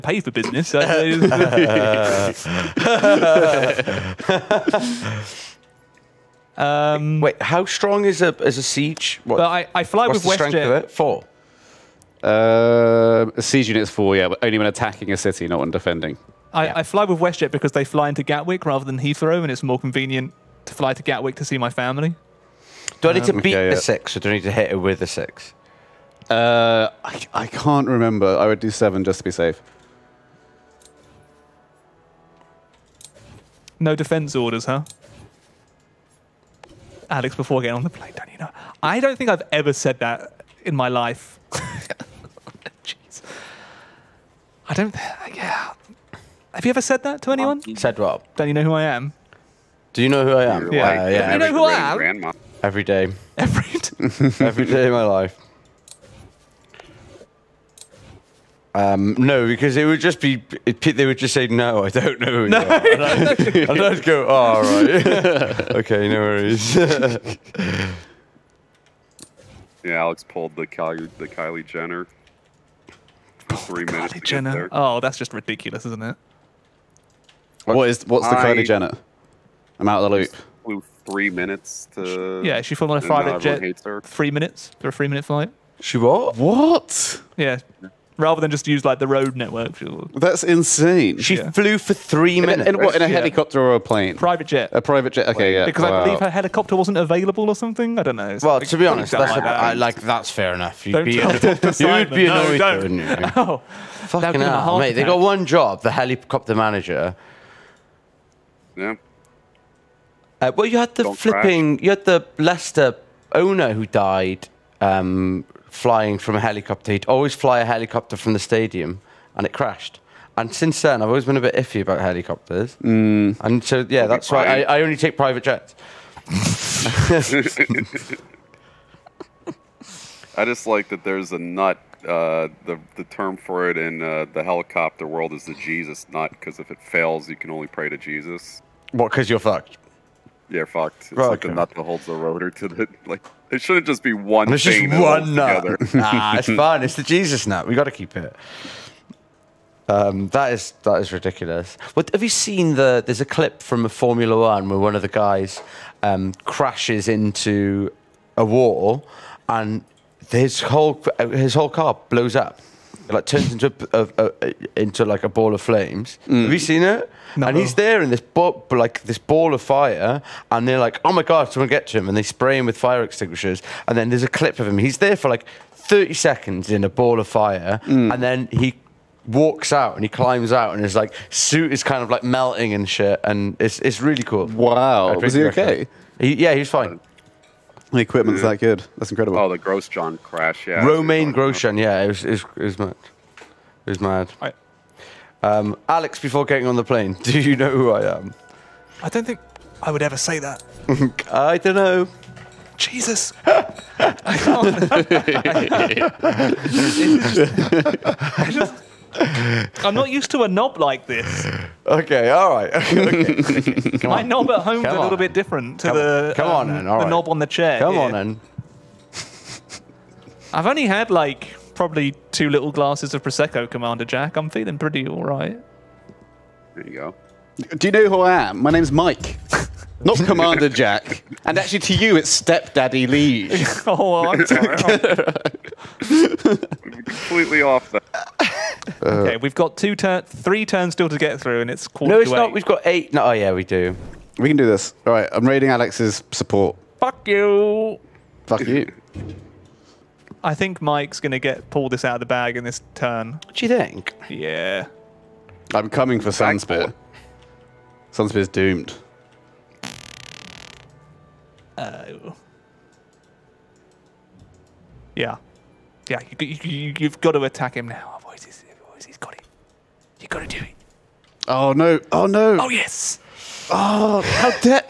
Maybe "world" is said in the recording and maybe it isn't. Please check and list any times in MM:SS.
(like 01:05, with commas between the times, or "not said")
02:15.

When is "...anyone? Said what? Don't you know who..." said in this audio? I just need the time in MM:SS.
00:47.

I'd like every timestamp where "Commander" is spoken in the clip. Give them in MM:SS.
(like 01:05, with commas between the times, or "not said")
03:43, 03:50.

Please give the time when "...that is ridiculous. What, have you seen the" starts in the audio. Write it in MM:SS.
02:30.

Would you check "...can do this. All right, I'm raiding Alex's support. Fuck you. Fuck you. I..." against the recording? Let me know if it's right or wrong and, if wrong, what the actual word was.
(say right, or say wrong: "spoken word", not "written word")
right.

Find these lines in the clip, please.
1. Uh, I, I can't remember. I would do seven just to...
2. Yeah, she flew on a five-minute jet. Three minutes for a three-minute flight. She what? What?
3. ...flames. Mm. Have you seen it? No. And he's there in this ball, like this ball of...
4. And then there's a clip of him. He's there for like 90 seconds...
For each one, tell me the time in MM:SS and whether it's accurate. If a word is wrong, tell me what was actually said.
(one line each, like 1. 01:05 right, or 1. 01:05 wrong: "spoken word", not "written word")
1. 00:26 right
2. 01:22 right
3. 02:45 right
4. 02:53 wrong: "30", not "90".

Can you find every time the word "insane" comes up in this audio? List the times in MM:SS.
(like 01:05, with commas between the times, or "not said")
01:30.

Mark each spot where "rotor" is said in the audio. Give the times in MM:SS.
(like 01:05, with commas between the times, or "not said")
02:22.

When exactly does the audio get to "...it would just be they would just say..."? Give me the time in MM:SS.
00:59.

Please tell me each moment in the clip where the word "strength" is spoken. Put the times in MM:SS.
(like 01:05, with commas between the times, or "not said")
00:10.